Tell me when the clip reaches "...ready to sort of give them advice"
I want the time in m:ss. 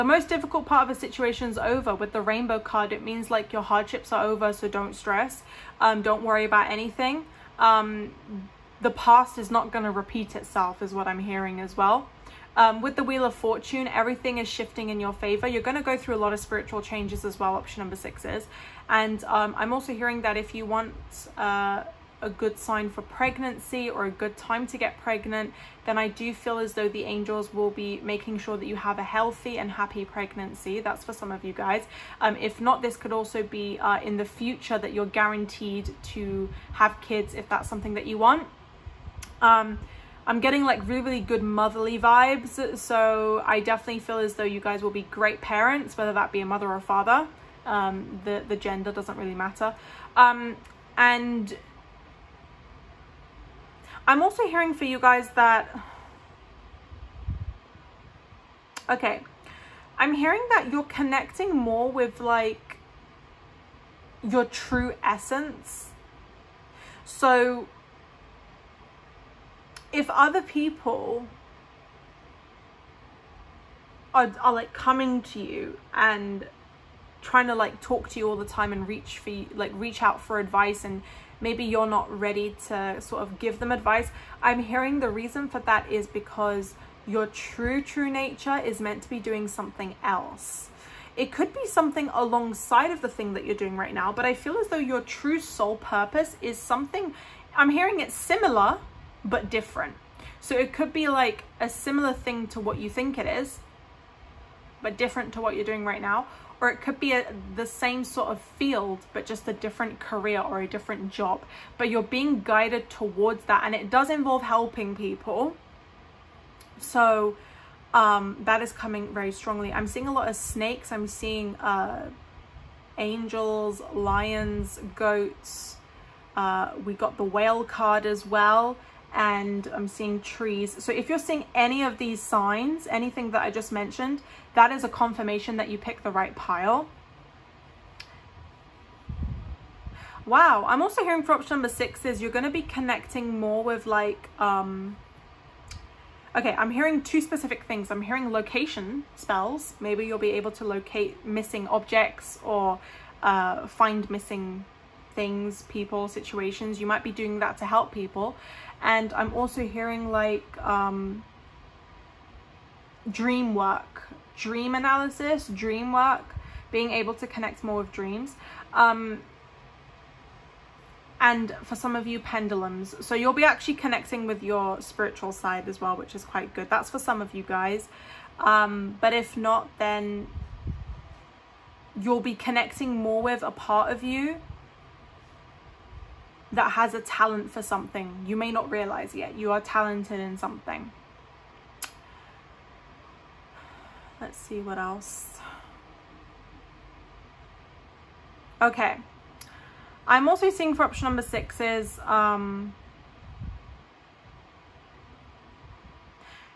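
1:22.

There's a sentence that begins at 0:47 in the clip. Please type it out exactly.
Um, the, the gender doesn't really matter.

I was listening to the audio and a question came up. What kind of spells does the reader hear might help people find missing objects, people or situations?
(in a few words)
location spells.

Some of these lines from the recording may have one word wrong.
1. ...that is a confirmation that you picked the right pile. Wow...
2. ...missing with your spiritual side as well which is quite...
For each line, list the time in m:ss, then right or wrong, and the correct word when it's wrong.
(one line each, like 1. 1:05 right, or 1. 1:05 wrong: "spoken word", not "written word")
1. 2:14 right
2. 2:53 wrong: "connecting", not "missing".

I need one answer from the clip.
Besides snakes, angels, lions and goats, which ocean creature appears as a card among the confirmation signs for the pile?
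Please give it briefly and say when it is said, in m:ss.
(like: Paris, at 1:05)
whale, at 2:07.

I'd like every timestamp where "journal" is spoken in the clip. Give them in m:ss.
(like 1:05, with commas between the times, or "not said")
not said.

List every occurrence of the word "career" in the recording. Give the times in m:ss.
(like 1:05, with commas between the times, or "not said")
1:49.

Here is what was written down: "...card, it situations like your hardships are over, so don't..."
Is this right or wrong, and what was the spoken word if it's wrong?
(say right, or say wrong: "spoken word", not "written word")
wrong: "means", not "situations".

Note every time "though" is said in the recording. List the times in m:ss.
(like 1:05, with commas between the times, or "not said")
0:26, 0:44, 1:34.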